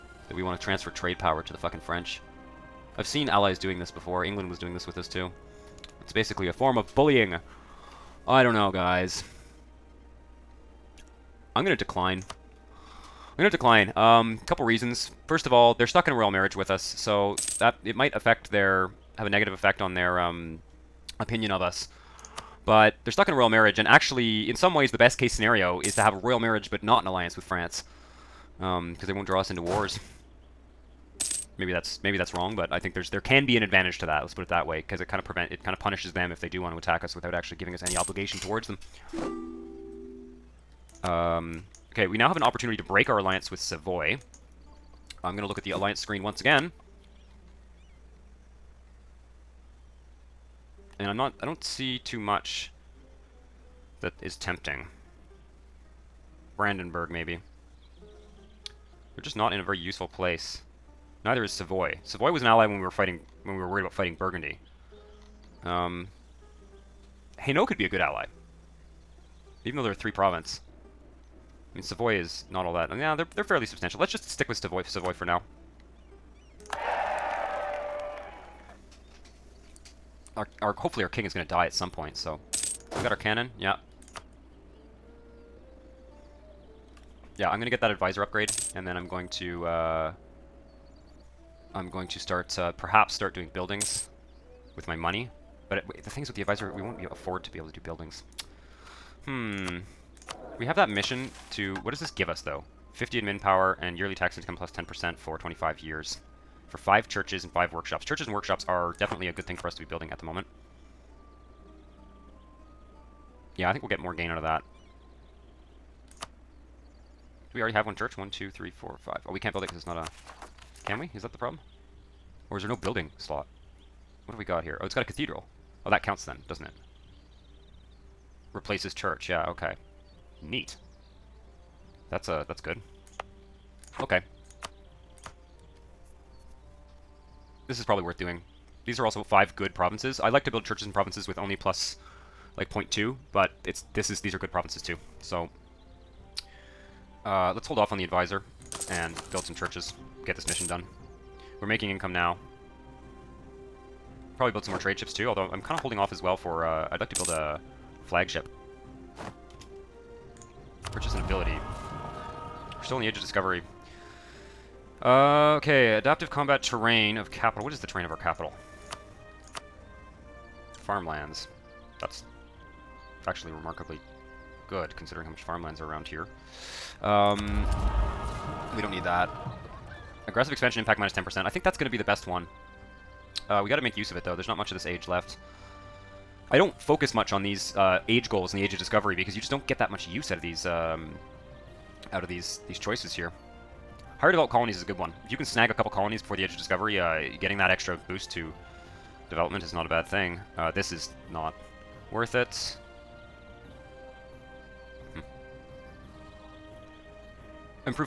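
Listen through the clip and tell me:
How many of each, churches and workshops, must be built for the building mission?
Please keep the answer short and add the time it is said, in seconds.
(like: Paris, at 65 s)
5, at 106 s.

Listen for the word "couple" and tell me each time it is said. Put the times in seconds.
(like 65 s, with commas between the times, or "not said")
14 s, 195 s.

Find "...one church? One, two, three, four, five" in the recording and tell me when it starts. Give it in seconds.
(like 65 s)
117 s.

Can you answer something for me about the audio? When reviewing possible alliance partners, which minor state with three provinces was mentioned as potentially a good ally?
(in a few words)
Hainaut.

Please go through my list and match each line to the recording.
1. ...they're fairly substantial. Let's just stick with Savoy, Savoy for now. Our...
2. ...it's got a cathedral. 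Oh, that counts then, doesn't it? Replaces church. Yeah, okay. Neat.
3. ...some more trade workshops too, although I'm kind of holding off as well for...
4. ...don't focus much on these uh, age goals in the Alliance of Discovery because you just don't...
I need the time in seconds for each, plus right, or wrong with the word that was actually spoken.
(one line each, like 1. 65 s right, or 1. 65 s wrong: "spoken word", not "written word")
1. 73 s right
2. 124 s right
3. 154 s wrong: "ships", not "workshops"
4. 186 s wrong: "Age", not "Alliance".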